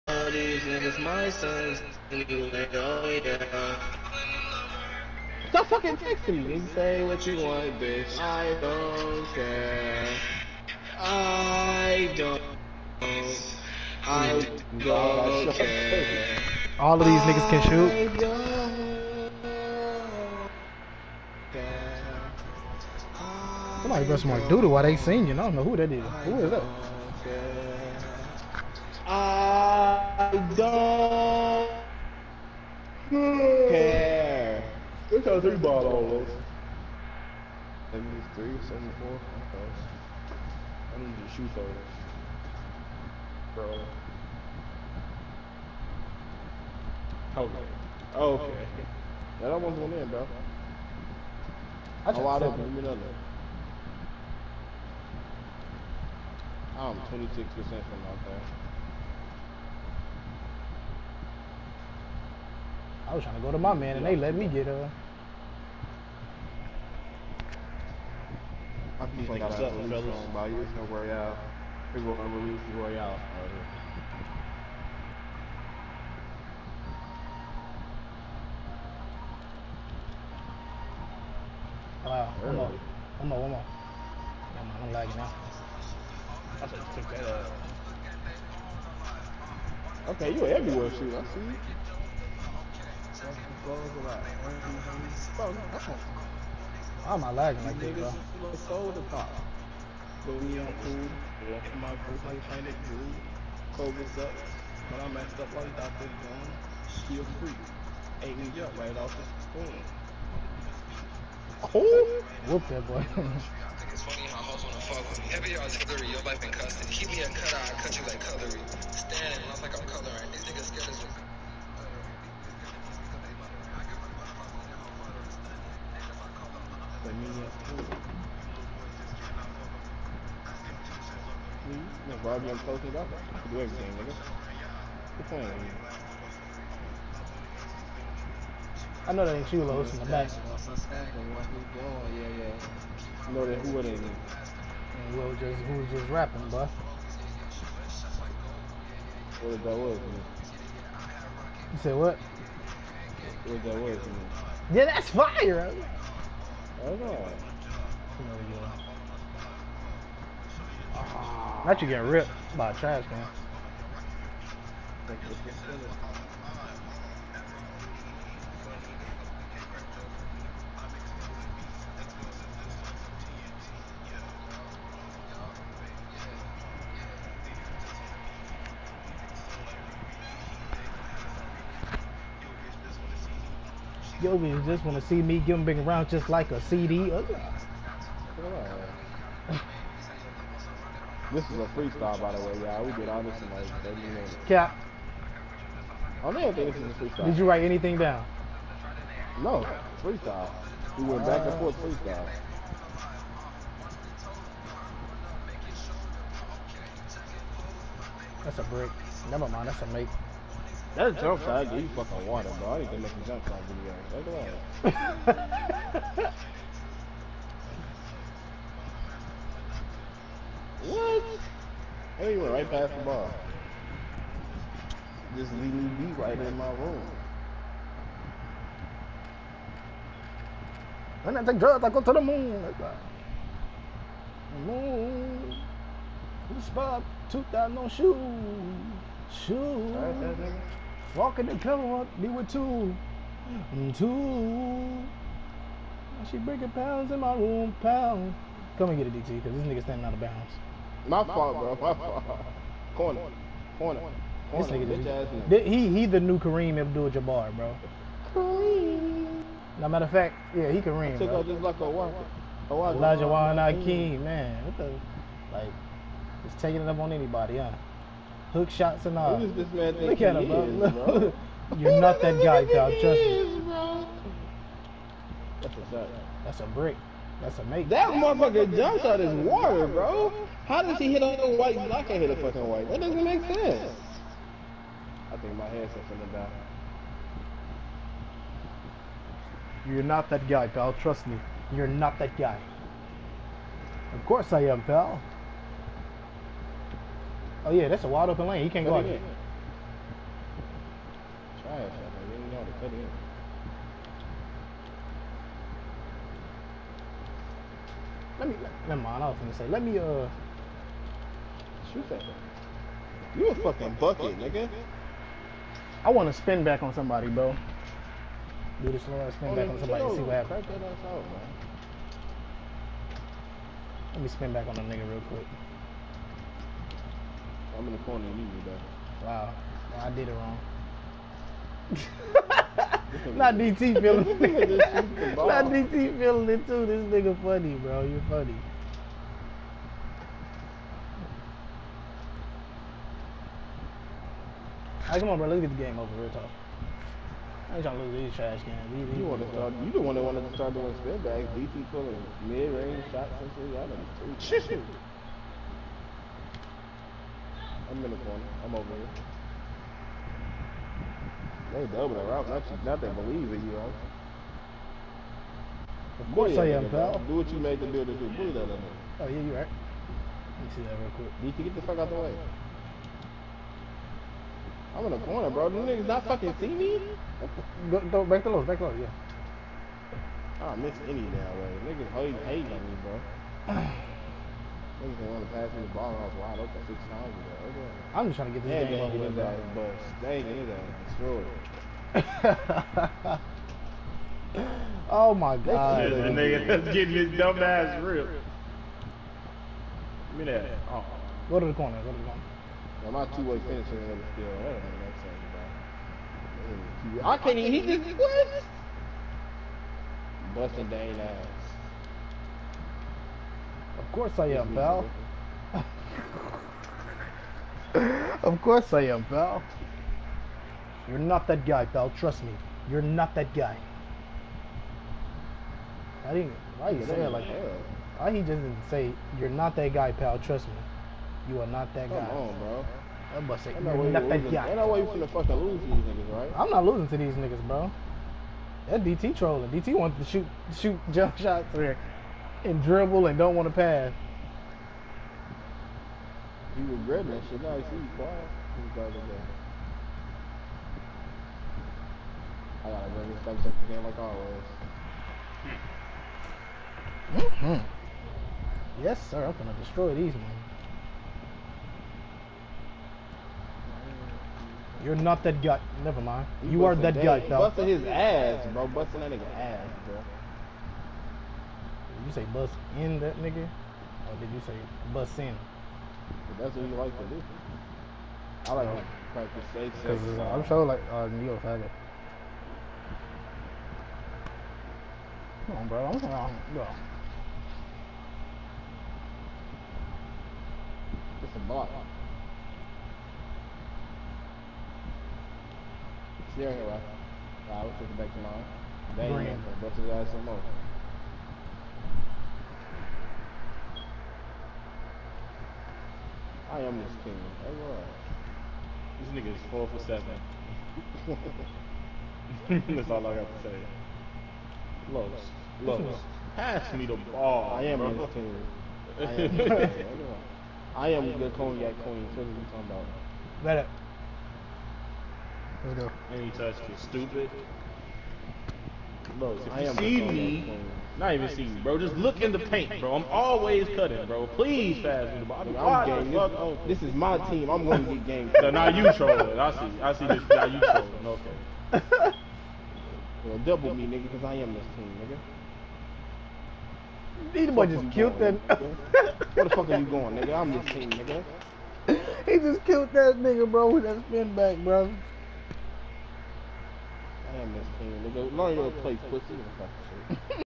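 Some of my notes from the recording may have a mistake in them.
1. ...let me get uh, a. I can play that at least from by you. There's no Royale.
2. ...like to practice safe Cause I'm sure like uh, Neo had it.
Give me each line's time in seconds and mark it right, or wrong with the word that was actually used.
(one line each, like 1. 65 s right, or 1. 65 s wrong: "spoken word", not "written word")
1. 64 s right
2. 478 s right.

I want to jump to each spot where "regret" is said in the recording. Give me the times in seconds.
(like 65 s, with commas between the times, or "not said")
446 s.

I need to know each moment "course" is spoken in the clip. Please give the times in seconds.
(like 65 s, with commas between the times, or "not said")
294 s, 366 s, 414 s, 418 s.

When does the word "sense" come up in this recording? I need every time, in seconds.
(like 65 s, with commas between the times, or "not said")
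283 s.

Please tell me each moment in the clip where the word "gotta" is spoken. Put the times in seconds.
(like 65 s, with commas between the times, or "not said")
448 s.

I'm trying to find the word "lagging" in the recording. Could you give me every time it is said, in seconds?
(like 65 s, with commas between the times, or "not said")
84 s, 97 s.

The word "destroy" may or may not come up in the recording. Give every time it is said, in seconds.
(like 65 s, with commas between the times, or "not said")
392 s, 459 s.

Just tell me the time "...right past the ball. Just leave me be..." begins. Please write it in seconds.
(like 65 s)
222 s.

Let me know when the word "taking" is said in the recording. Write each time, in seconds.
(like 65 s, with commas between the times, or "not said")
266 s, 497 s.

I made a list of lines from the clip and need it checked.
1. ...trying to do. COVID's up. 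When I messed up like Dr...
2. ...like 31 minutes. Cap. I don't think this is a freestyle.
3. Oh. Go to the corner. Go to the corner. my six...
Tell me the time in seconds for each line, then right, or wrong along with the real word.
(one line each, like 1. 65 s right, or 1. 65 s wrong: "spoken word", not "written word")
1. 102 s right
2. 193 s wrong: "30", not "31"
3. 400 s wrong: "two", not "six".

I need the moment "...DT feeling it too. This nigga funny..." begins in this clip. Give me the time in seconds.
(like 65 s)
335 s.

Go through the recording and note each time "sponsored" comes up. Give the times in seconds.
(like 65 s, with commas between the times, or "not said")
not said.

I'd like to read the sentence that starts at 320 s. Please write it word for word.
Out, Let me spin back on the nigga real quick.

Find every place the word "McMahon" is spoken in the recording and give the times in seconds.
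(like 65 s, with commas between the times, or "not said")
not said.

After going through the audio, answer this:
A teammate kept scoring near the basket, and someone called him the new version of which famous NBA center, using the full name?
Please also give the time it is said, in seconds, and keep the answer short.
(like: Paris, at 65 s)
Kareem Abdul-Jabbar, at 256 s.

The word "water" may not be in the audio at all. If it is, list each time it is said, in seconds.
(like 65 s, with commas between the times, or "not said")
212 s, 279 s.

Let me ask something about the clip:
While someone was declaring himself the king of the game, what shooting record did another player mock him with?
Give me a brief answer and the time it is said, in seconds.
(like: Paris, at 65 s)
4 for 7, at 509 s.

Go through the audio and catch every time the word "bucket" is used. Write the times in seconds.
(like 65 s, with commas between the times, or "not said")
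313 s.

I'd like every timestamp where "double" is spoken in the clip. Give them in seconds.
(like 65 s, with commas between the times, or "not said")
361 s, 543 s.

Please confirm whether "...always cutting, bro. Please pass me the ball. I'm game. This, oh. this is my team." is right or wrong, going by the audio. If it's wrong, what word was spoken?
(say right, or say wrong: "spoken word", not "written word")
right.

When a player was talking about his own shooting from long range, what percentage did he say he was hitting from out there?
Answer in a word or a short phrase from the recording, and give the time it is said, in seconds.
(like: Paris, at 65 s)
26%, at 56 s.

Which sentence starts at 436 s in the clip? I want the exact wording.
I'm not losing to these niggas, bro.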